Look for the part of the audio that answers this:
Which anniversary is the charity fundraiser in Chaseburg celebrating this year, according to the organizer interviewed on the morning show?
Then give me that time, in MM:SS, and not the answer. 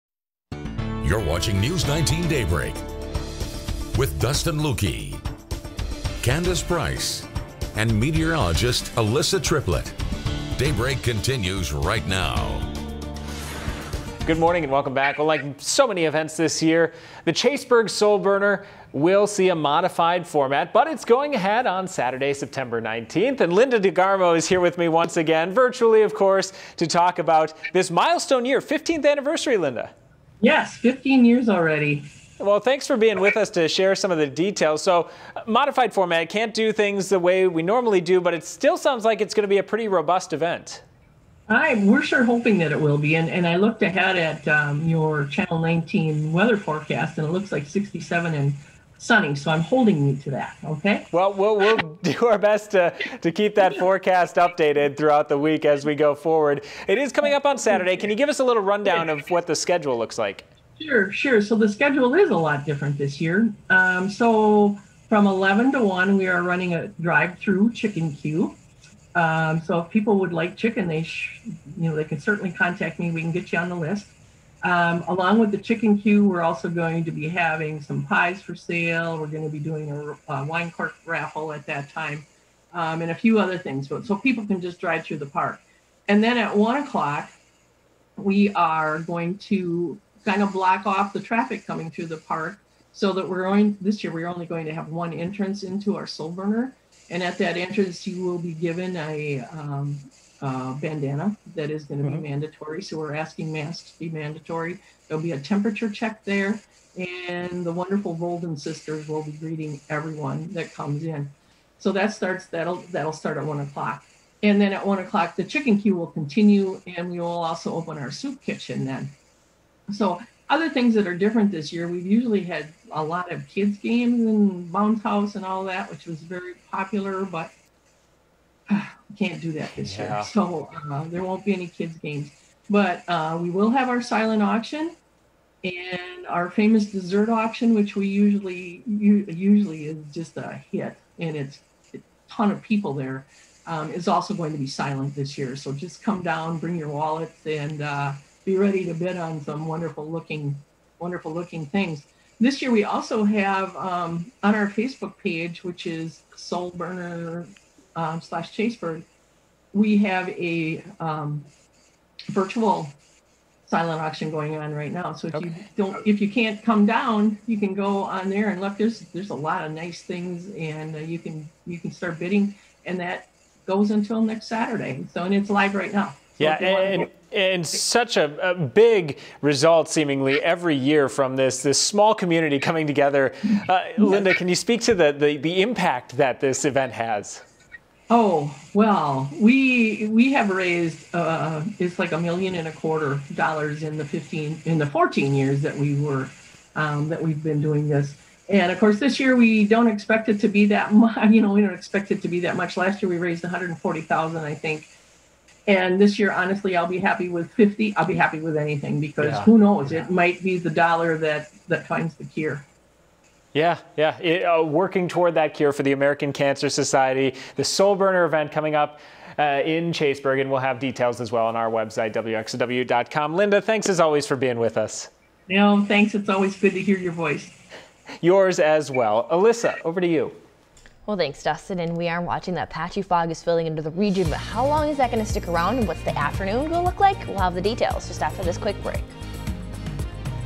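00:28.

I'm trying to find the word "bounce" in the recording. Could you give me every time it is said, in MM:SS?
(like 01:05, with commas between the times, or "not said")
02:04.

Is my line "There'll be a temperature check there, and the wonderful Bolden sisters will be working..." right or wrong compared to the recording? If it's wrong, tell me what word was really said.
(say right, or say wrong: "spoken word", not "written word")
wrong: "greeting", not "working".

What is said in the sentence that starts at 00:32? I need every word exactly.
Well, thanks for being with us to share some of the details.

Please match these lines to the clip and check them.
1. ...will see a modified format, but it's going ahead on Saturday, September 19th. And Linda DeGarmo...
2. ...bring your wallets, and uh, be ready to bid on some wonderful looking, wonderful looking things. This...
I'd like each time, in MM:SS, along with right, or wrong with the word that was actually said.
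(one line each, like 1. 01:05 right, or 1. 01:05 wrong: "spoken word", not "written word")
1. 00:18 right
2. 02:26 right.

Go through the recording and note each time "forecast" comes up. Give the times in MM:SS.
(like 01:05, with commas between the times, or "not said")
00:46, 00:53.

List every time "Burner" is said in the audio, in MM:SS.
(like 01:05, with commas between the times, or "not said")
00:18, 01:36, 02:36, 03:37.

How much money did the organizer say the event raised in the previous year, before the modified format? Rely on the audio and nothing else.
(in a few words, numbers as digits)
$140,000.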